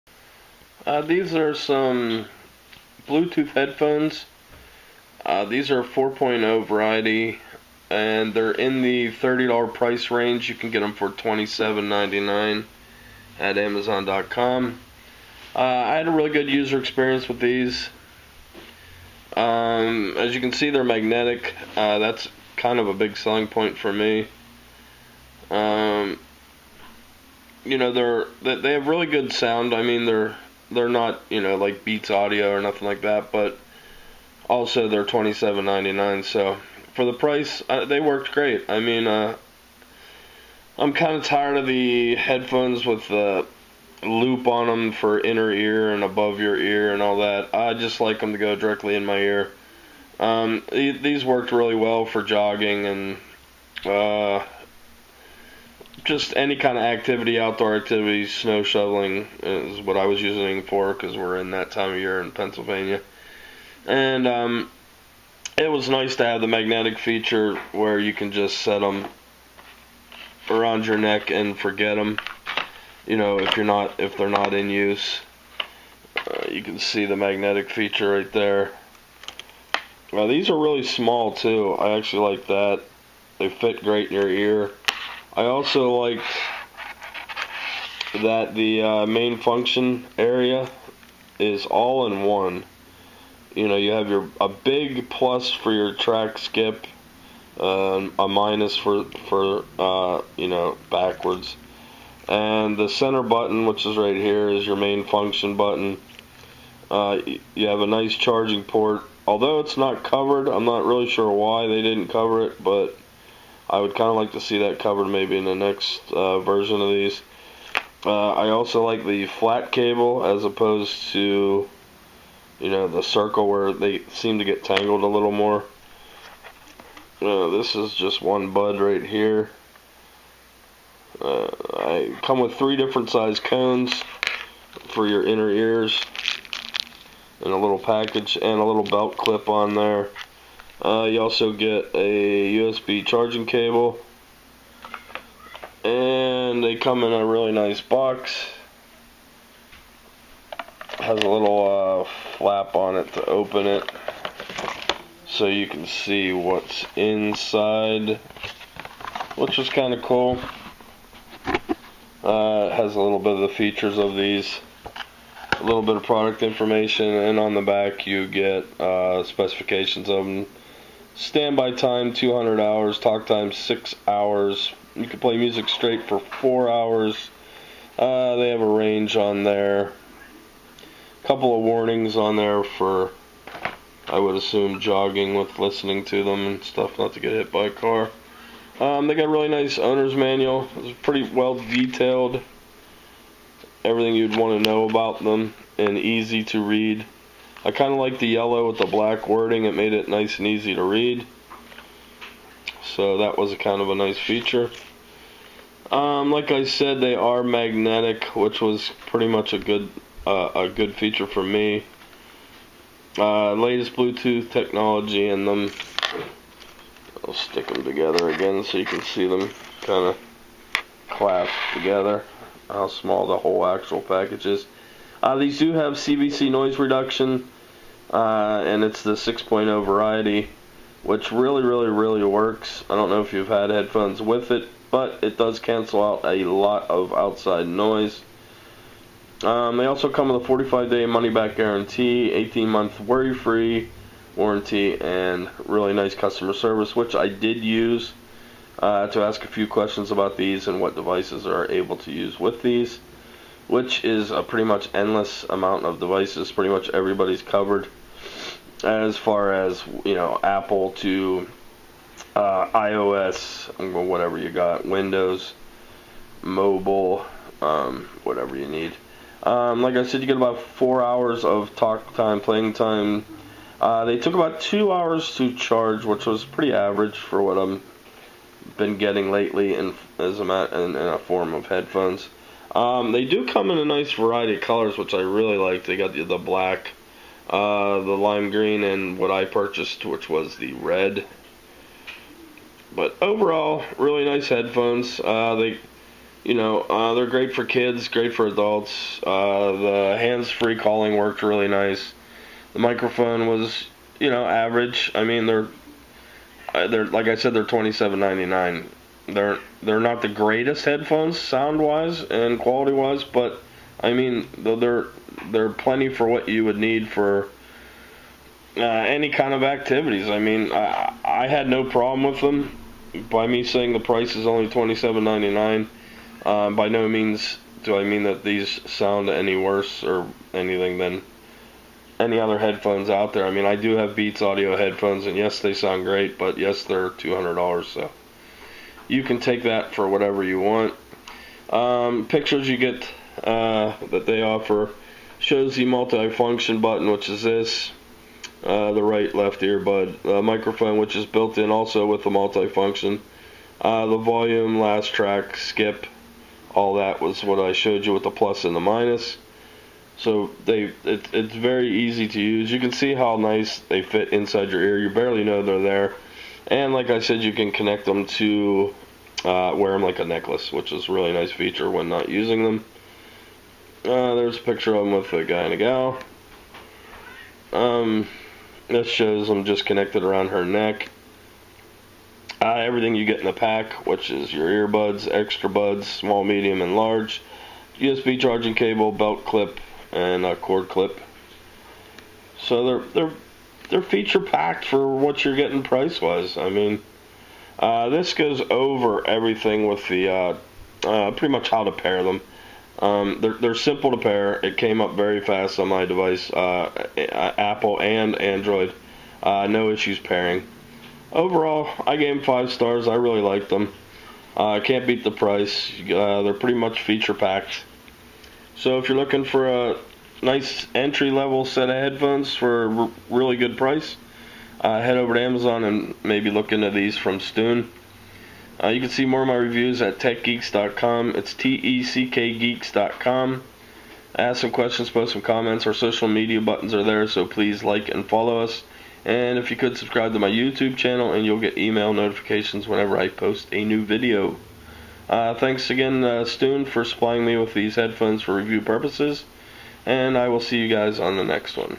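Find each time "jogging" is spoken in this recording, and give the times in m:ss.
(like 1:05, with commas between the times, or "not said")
0:52, 3:04.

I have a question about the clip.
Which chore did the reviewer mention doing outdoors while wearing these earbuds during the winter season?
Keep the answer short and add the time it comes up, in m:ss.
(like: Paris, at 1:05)
Snow shoveling, at 0:58.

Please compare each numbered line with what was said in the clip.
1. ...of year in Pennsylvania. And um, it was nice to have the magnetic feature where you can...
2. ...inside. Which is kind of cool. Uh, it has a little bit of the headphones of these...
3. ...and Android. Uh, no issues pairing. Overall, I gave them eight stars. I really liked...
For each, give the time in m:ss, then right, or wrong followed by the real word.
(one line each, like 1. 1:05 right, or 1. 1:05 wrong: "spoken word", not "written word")
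1. 1:01 right
2. 2:36 wrong: "features", not "headphones"
3. 6:48 wrong: "five", not "eight".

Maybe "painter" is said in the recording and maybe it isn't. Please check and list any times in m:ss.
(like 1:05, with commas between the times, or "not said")
not said.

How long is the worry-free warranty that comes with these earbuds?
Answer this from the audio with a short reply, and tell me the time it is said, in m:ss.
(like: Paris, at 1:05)
18 months, at 4:02.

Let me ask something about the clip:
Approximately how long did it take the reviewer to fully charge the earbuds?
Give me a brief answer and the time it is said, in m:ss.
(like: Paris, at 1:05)
2 hours, at 4:34.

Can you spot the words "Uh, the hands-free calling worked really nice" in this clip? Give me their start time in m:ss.
4:59.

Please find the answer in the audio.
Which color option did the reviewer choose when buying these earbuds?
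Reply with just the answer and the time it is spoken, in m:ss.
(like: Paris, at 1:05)
Red, at 4:50.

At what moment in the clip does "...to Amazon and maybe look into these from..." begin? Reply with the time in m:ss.
7:05.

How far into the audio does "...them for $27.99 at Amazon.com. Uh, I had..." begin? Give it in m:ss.
0:10.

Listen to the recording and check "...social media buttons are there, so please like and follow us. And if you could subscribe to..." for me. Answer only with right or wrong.
right.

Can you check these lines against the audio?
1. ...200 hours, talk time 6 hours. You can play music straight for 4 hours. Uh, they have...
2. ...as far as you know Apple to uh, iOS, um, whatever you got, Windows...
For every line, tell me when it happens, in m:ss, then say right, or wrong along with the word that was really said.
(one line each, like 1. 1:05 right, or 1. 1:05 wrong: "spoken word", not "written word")
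1. 2:52 right
2. 4:18 right.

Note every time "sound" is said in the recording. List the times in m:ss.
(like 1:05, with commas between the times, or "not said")
0:29, 5:11, 5:28, 5:35.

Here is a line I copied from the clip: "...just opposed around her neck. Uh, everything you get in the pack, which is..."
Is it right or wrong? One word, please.
wrong.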